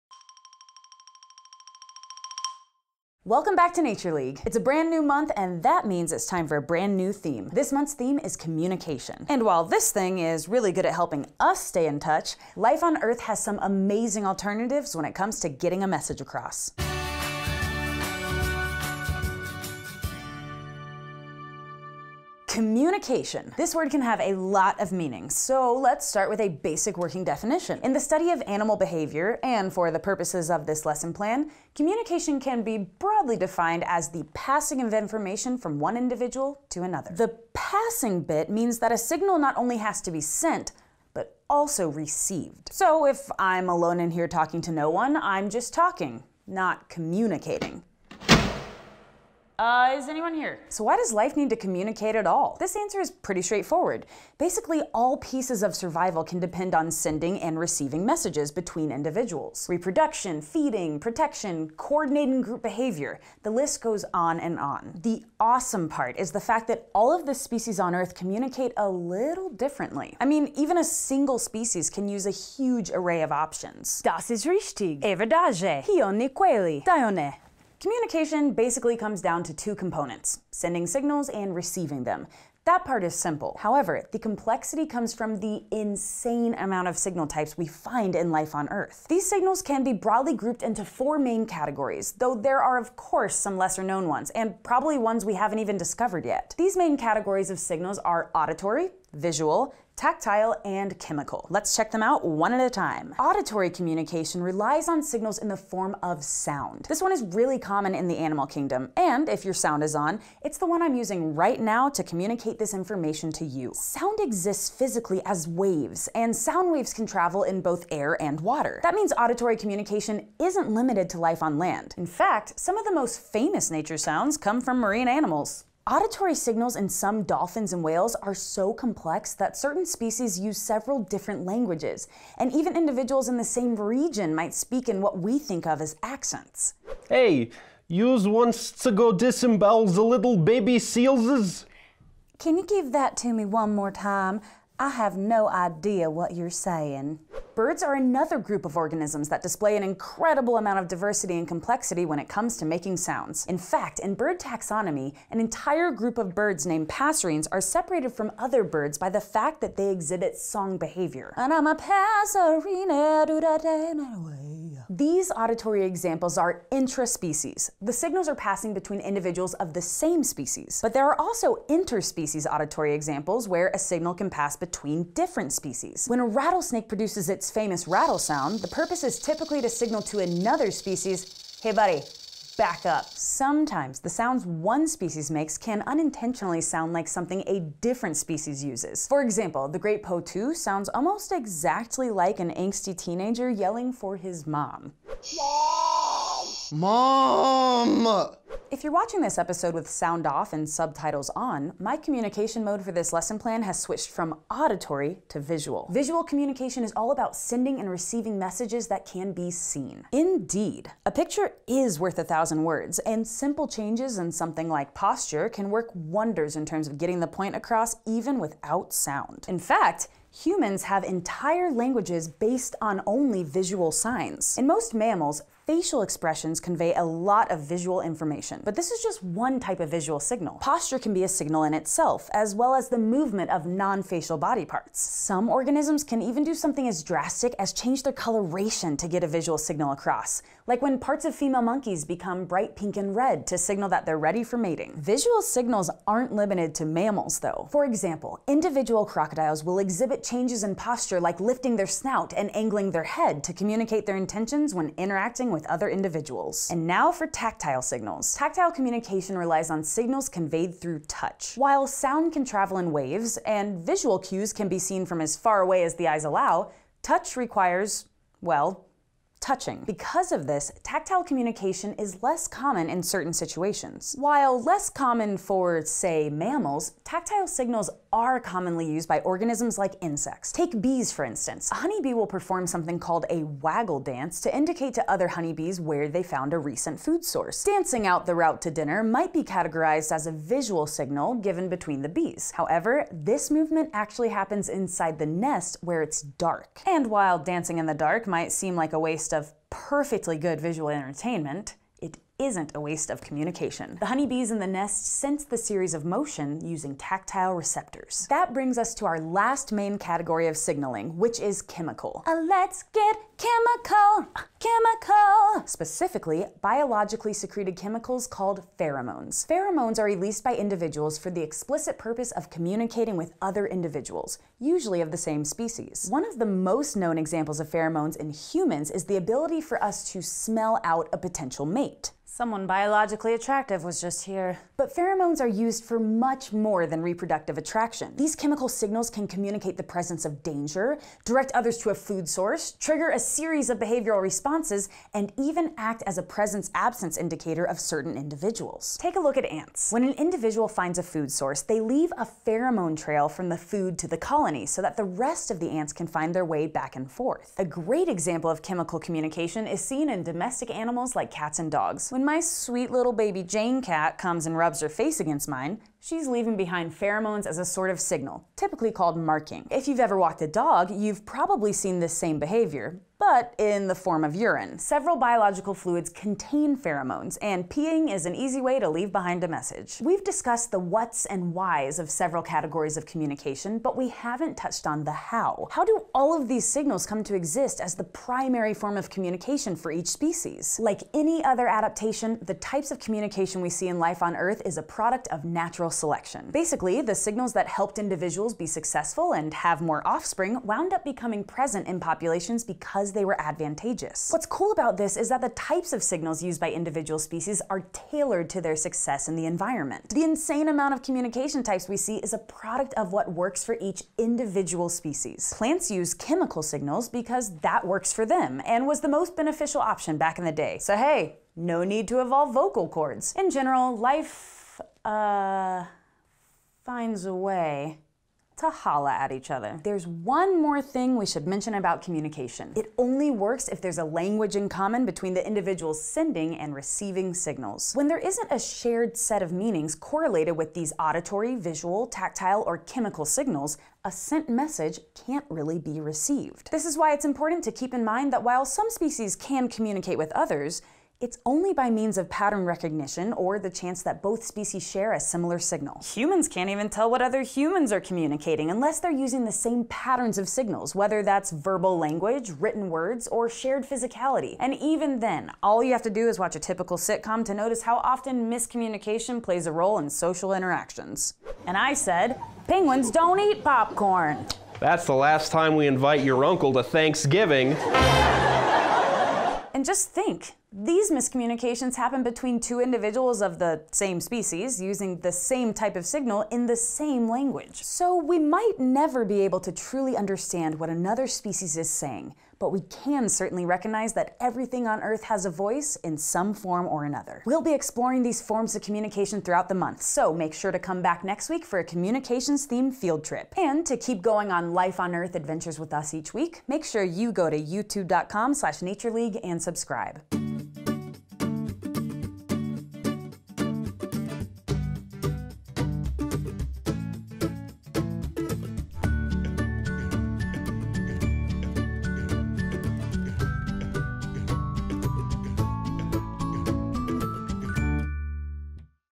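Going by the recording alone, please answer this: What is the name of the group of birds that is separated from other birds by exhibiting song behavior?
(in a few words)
Passerines.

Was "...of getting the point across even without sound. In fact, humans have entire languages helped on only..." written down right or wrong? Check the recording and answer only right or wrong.
wrong.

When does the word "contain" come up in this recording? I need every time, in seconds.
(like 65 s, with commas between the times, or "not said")
376 s.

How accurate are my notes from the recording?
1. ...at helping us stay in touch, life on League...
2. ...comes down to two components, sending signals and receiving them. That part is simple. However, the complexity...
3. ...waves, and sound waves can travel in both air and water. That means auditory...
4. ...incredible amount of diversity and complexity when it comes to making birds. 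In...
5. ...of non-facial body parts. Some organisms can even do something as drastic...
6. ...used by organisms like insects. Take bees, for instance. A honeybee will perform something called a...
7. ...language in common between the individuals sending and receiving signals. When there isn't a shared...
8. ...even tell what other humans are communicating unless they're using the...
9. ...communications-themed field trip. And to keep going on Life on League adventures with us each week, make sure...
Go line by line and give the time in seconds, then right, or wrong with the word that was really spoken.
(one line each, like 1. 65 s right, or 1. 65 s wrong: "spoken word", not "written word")
1. 10 s wrong: "Earth", not "League"
2. 78 s right
3. 115 s right
4. 149 s wrong: "sounds", not "birds"
5. 233 s right
6. 278 s right
7. 434 s right
8. 456 s right
9. 501 s wrong: "Earth", not "League".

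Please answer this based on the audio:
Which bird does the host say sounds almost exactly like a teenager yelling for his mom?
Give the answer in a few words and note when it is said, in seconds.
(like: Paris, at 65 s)
Great potoo, at 189 s.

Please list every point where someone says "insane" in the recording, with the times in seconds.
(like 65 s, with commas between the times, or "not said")
85 s, 410 s.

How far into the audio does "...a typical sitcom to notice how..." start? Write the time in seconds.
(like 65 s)
466 s.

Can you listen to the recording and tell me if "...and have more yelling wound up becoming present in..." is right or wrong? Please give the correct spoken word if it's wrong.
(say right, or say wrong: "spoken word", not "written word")
wrong: "offspring", not "yelling".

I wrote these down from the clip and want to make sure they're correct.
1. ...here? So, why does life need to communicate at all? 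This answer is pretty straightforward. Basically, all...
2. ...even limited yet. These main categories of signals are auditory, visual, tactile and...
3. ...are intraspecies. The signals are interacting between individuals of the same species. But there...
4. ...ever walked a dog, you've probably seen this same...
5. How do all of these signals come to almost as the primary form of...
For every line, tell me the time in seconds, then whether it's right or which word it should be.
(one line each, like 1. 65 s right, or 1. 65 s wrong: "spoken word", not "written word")
1. 50 s right
2. 95 s wrong: "discovered", not "limited"
3. 166 s wrong: "passing", not "interacting"
4. 369 s right
5. 385 s wrong: "exist", not "almost".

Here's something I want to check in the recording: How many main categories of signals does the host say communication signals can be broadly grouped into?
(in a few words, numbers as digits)
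4.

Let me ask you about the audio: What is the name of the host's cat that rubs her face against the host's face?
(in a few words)
Jane.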